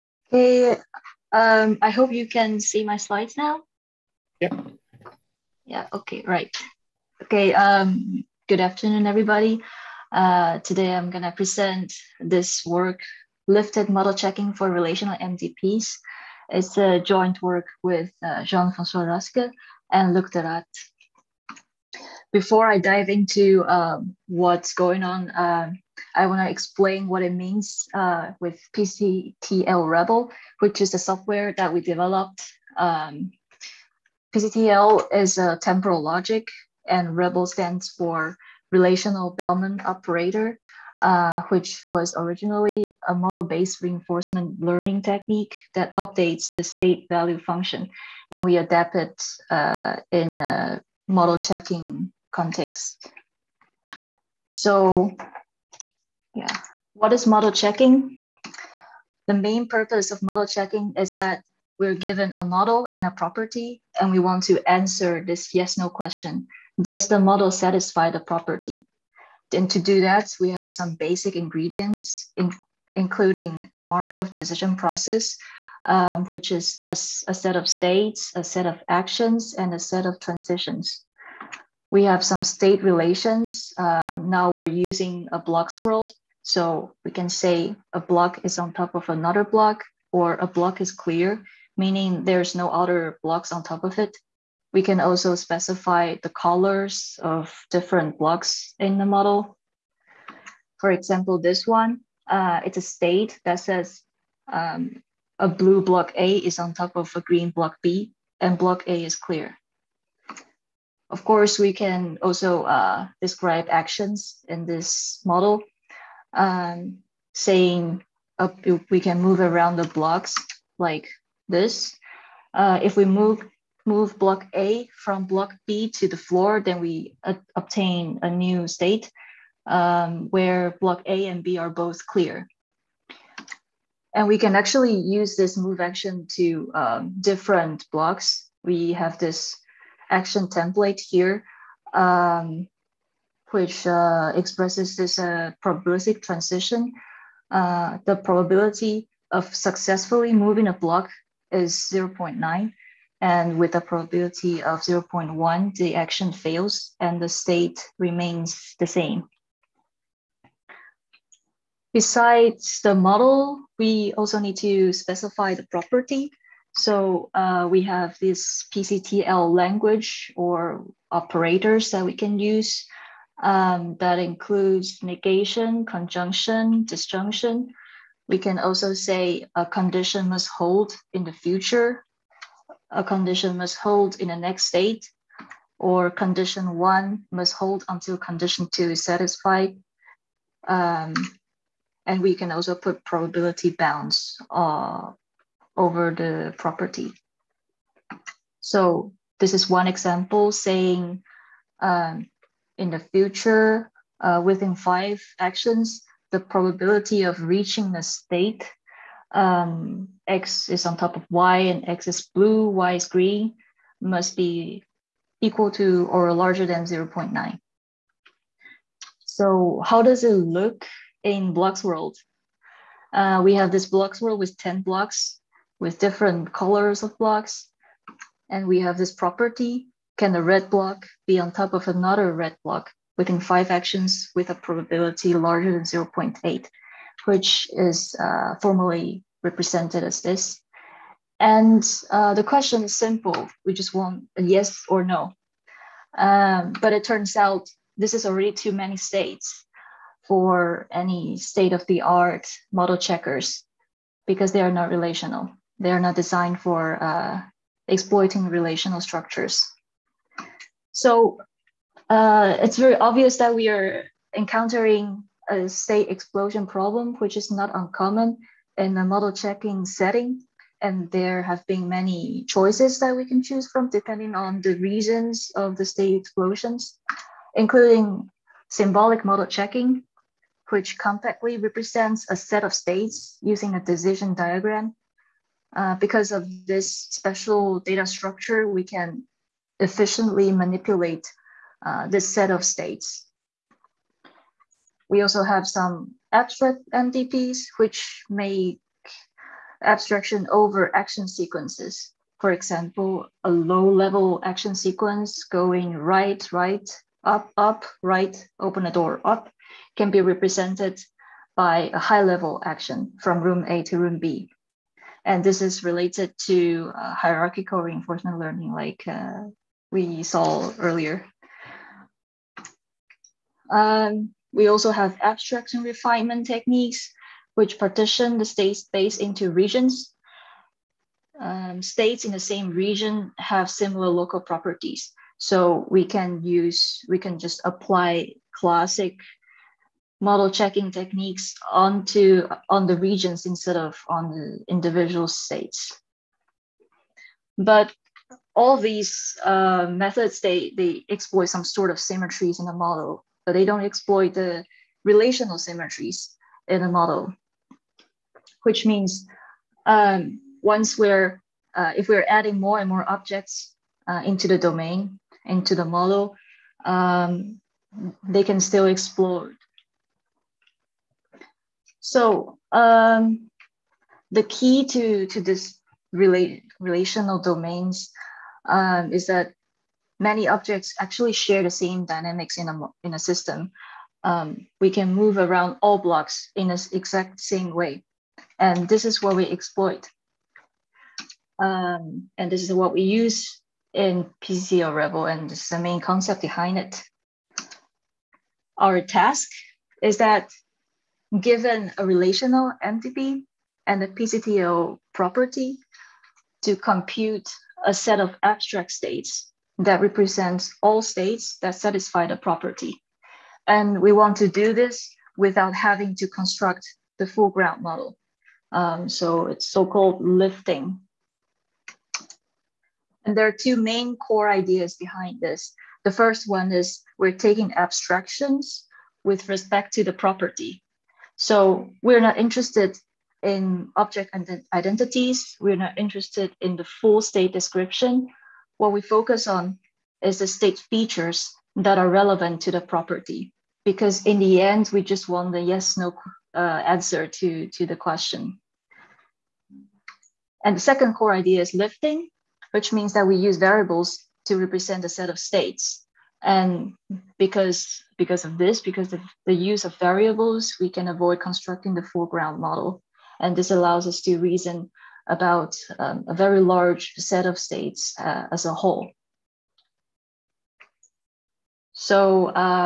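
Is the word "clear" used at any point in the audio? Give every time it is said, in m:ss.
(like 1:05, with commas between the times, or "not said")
1:30, 1:49, 2:12.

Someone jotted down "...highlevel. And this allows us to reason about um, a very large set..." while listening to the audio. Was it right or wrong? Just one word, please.
wrong.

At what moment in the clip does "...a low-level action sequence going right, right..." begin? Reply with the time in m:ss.
5:03.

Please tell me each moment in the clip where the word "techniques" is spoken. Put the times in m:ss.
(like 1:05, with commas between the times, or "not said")
0:45, 5:26, 5:40.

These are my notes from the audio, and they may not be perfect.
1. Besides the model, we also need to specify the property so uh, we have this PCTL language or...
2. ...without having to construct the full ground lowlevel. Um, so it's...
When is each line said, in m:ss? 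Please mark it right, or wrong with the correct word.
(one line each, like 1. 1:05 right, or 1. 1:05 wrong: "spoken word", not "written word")
1. 2:41 right
2. 6:55 wrong: "model", not "lowlevel".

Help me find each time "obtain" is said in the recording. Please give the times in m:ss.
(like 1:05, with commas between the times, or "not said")
2:07.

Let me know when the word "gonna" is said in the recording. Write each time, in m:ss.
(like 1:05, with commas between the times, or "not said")
0:11.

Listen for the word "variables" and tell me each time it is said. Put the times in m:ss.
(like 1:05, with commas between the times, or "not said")
7:33, 7:39.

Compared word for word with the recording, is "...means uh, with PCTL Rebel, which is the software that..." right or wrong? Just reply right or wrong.
right.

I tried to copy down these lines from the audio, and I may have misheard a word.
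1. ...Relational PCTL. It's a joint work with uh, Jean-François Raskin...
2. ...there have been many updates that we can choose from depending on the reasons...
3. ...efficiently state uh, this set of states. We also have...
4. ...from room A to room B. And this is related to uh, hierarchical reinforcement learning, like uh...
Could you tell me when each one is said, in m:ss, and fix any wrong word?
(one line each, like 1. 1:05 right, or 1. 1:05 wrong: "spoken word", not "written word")
1. 0:14 wrong: "MDPs", not "PCTL"
2. 4:31 wrong: "choices", not "updates"
3. 4:49 wrong: "manipulate", not "state"
4. 5:13 right.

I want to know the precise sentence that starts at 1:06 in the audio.
Does the model satisfy the property?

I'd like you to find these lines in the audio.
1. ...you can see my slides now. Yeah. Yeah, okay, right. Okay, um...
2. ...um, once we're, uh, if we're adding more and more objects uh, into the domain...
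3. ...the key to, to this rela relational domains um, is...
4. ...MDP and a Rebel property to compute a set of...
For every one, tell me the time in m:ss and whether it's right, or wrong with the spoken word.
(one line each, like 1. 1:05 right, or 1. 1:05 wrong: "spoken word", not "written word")
1. 0:02 right
2. 5:59 right
3. 6:14 right
4. 6:42 wrong: "PCTL", not "Rebel".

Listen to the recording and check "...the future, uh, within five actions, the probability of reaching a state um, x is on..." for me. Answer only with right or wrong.
right.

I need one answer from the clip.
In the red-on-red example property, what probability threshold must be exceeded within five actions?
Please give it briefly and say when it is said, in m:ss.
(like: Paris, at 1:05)
0.8, at 3:55.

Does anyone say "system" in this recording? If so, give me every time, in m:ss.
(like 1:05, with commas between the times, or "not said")
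6:23.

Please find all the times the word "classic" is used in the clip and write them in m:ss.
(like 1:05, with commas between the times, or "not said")
5:38.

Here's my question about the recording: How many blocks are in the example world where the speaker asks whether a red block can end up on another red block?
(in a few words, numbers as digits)
10.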